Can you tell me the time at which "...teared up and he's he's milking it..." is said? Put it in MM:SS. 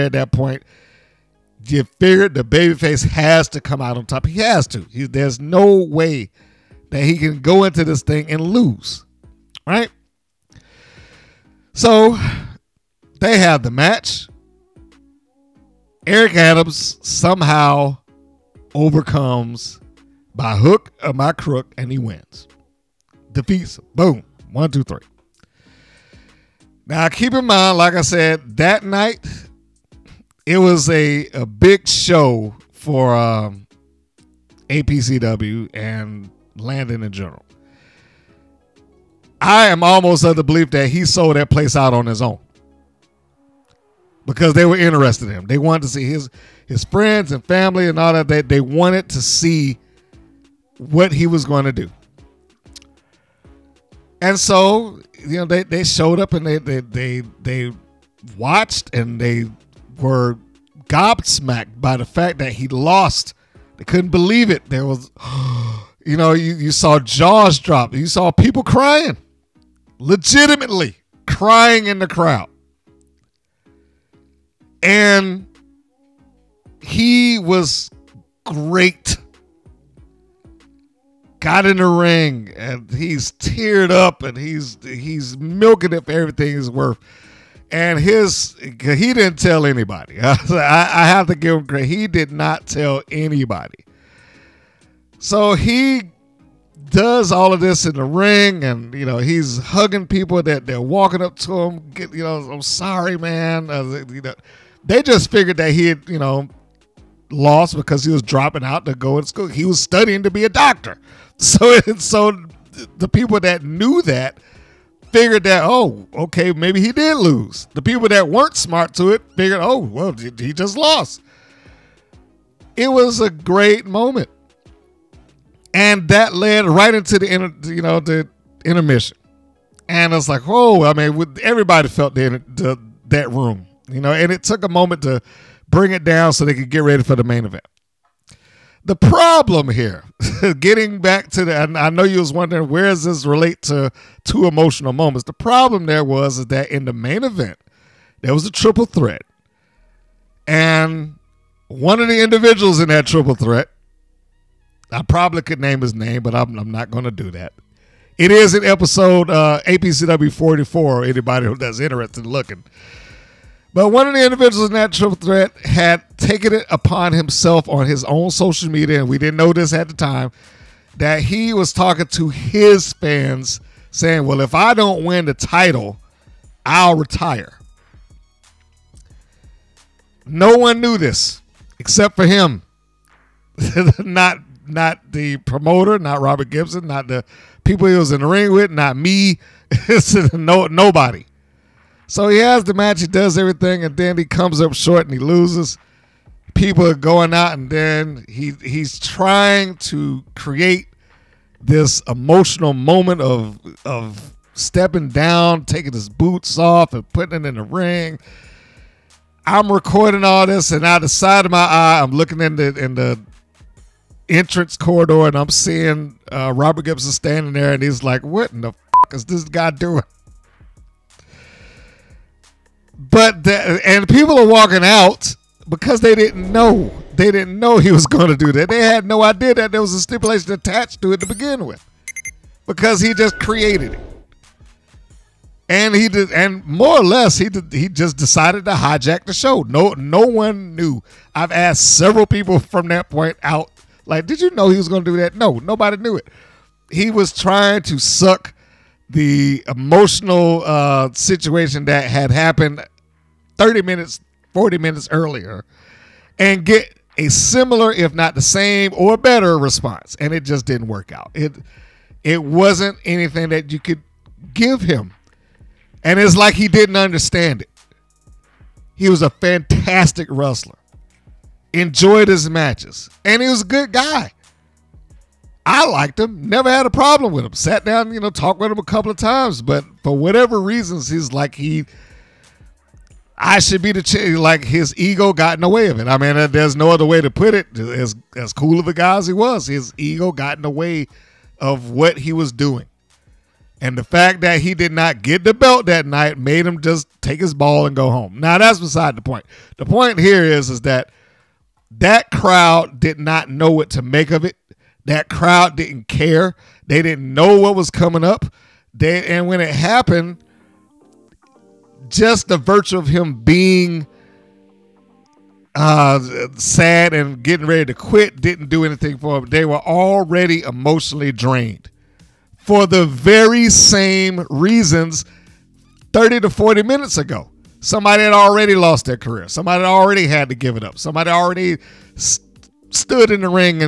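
01:23.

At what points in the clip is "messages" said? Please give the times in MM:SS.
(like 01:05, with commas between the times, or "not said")
not said.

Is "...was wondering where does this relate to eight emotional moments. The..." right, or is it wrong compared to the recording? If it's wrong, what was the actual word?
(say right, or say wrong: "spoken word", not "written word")
wrong: "two", not "eight".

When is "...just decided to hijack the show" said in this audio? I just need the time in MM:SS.
03:57.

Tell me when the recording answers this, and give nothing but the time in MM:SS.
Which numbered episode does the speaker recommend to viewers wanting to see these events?
02:39.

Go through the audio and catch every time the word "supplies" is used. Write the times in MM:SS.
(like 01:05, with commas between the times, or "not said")
not said.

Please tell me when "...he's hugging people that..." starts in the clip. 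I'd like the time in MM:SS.
01:39.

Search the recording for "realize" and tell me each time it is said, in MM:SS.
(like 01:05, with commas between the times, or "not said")
not said.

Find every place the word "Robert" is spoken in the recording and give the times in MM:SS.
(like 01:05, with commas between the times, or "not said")
03:06, 03:36.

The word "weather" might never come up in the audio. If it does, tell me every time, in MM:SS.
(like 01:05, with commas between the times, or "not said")
not said.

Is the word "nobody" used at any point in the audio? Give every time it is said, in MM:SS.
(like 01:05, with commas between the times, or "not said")
03:10, 04:05.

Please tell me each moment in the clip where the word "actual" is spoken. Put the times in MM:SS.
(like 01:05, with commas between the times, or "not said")
not said.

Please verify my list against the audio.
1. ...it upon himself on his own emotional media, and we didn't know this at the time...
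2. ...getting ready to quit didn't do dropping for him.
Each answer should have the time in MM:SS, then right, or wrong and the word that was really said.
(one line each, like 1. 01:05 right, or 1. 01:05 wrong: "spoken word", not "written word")
1. 02:46 wrong: "social", not "emotional"
2. 05:17 wrong: "anything", not "dropping".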